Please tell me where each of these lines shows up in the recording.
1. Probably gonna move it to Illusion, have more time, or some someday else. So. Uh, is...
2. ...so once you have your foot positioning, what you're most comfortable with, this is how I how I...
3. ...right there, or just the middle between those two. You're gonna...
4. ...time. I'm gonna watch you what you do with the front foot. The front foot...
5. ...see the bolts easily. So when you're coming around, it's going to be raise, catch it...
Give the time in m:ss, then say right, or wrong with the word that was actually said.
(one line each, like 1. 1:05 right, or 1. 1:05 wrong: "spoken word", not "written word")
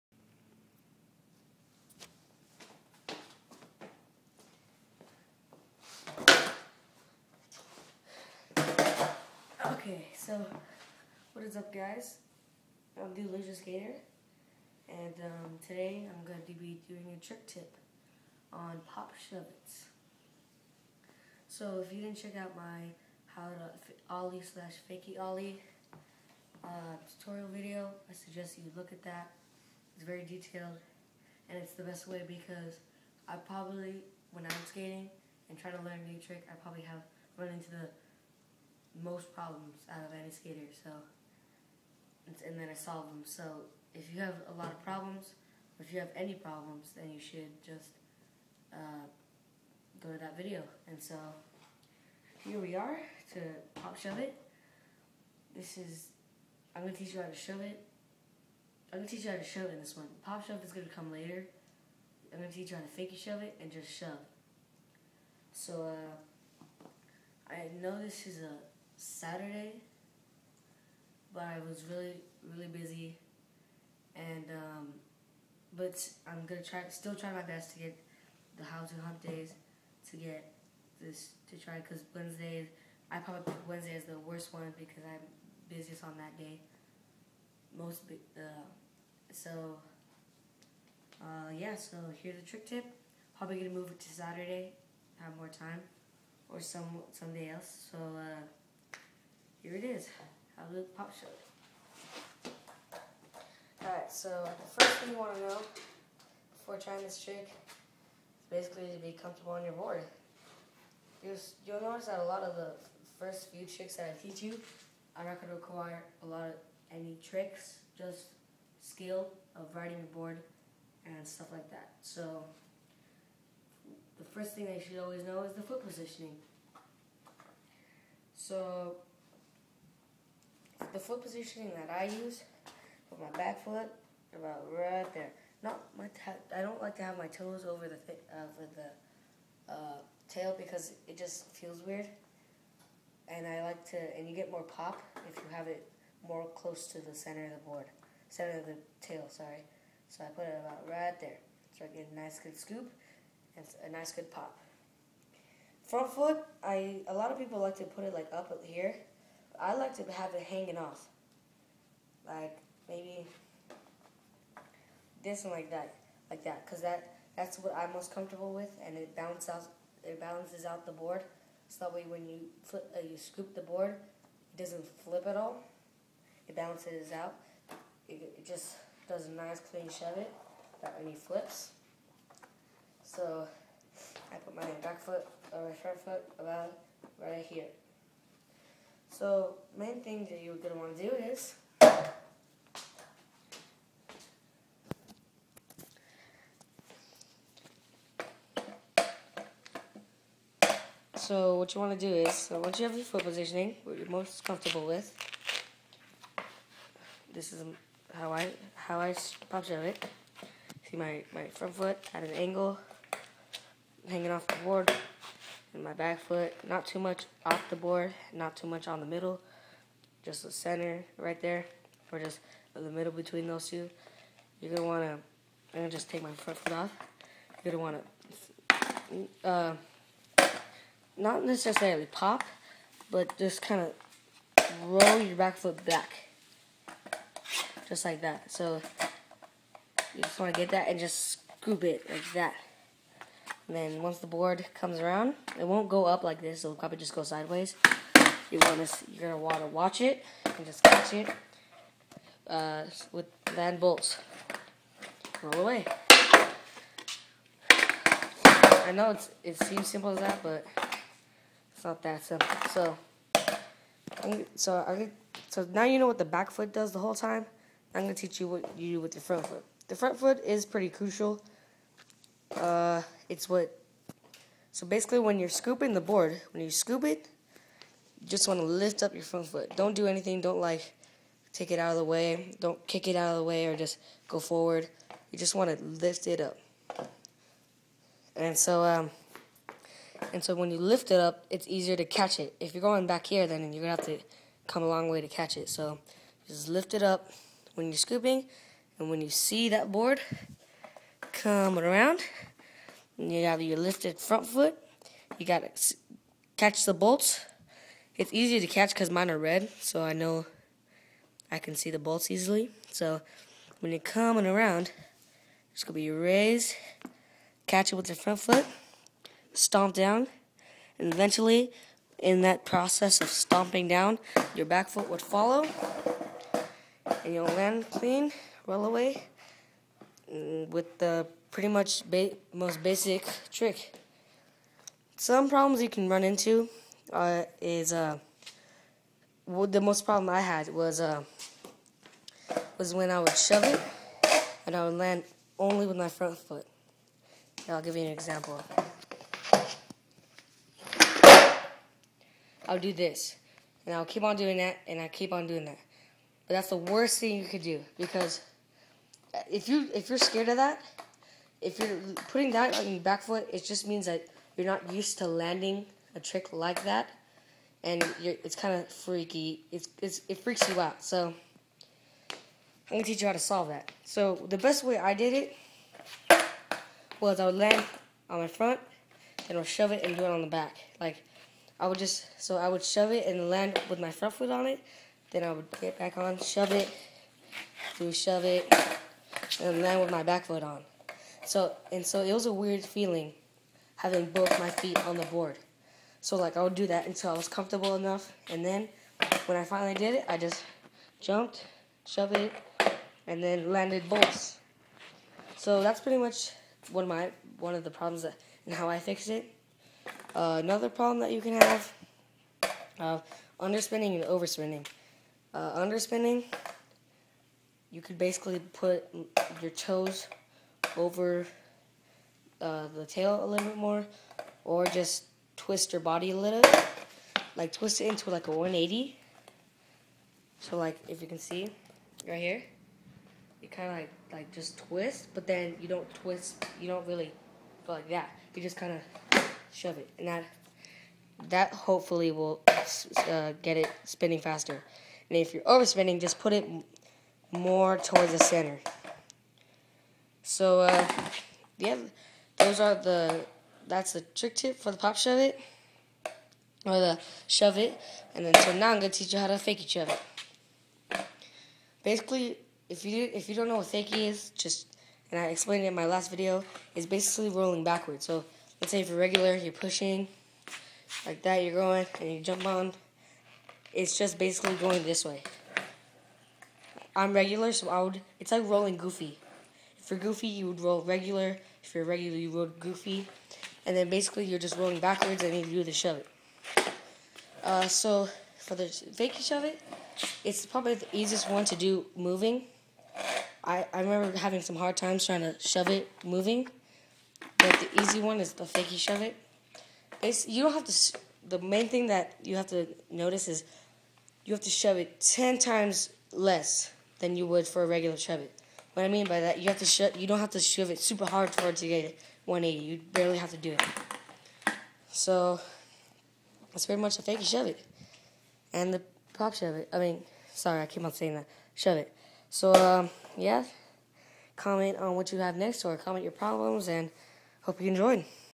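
1. 1:33 wrong: "Saturday", not "Illusion"
2. 3:22 right
3. 3:41 right
4. 4:27 wrong: "teach", not "watch"
5. 5:11 right.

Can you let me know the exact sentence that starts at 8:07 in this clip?
Uh, so for the fakie shove it, it's probably the easiest one to do moving.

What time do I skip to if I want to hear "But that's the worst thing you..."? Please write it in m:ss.
5:56.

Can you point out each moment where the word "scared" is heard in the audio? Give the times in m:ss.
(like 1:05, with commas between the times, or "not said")
6:00.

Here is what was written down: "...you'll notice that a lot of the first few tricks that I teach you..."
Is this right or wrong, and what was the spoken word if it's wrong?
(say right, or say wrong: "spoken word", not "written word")
right.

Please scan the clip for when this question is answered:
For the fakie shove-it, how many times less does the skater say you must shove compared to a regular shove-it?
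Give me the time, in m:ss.
8:25.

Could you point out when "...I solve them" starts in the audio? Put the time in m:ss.
0:42.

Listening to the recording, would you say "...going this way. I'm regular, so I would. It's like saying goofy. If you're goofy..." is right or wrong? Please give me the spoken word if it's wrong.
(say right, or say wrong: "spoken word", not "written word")
wrong: "rolling", not "saying".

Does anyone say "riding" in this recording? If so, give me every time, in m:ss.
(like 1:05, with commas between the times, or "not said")
1:59.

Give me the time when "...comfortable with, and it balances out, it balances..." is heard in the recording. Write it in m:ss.
2:48.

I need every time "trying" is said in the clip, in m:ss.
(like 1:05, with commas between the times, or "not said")
0:35, 1:46, 8:15.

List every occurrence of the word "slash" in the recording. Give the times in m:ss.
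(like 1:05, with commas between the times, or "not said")
0:24.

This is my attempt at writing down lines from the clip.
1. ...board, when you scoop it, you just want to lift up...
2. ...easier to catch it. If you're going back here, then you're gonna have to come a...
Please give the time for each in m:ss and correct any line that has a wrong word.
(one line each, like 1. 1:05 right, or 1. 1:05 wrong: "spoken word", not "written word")
1. 4:36 right
2. 4:51 right.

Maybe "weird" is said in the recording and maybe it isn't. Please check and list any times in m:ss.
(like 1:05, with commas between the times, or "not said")
2:21, 6:32.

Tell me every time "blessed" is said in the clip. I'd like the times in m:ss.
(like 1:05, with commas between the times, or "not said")
not said.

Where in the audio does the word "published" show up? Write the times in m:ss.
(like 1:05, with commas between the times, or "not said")
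not said.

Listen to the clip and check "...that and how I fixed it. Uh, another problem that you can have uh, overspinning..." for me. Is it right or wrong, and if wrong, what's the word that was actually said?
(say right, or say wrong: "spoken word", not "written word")
wrong: "underspinning", not "overspinning".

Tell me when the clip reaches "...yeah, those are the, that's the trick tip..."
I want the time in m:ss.
7:31.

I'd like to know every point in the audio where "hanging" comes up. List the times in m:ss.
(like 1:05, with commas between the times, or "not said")
2:40, 3:34.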